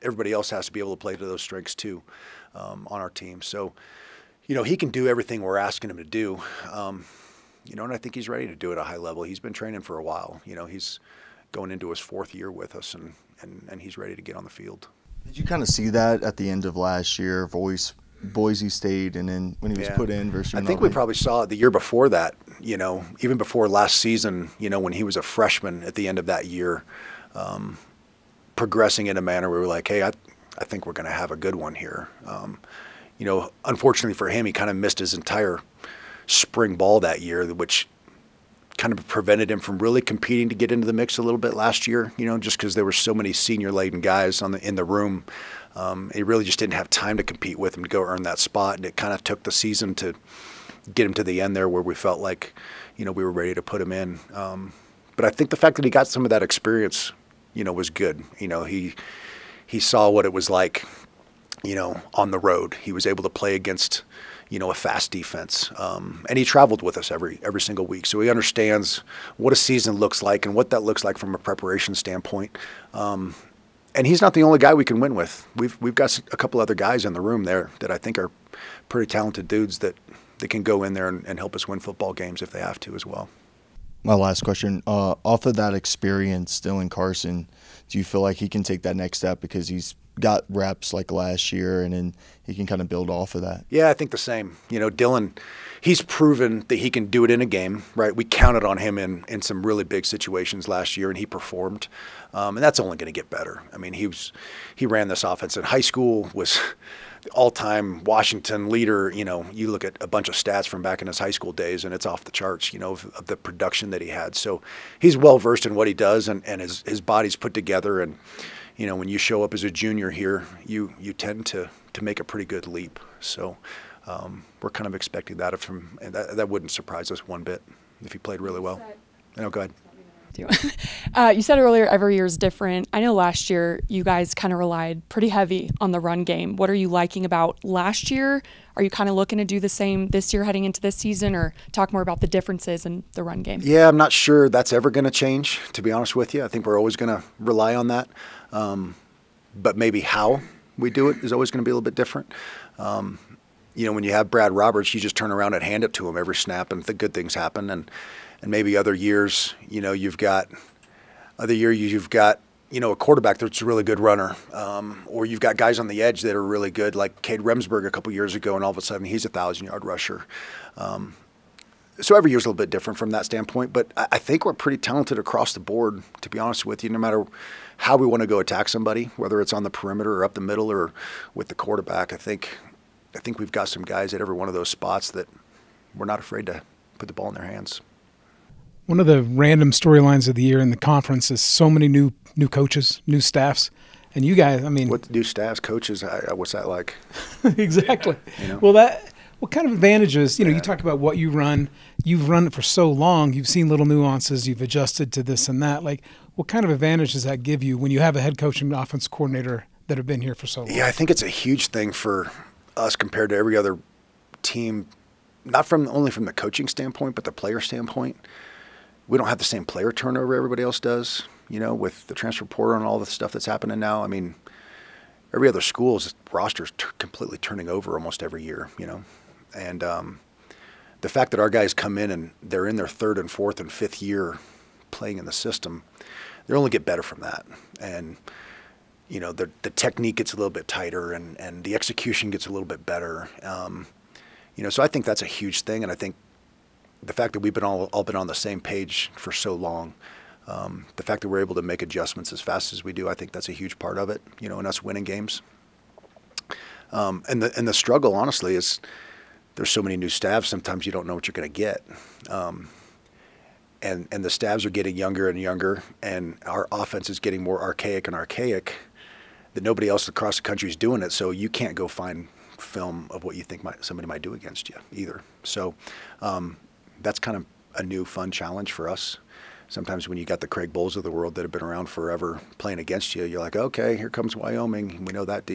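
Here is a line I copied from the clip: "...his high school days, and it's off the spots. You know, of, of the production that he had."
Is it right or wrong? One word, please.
wrong.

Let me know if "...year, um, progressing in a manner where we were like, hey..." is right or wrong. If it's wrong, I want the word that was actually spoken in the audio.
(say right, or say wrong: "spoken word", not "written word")
right.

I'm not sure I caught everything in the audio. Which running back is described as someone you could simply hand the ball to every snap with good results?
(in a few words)
Brad Roberts.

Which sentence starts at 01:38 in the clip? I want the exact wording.
We counted on him in in some really big situations last year, and he performed.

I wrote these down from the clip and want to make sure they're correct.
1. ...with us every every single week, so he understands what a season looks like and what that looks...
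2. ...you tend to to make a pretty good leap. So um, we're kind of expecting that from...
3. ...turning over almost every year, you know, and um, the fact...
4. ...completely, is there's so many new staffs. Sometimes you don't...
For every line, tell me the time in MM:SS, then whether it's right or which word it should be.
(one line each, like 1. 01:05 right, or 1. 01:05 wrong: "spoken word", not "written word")
1. 01:06 right
2. 02:00 right
3. 03:47 right
4. 04:18 wrong: "honestly", not "completely".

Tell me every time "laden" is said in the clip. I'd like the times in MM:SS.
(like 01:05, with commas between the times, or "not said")
00:43.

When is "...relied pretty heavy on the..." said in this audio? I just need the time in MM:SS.
02:14.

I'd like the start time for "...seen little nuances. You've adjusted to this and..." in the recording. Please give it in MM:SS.
03:23.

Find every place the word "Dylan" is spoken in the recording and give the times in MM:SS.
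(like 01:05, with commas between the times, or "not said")
01:26, 01:34.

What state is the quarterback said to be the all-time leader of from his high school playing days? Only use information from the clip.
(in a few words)
Washington.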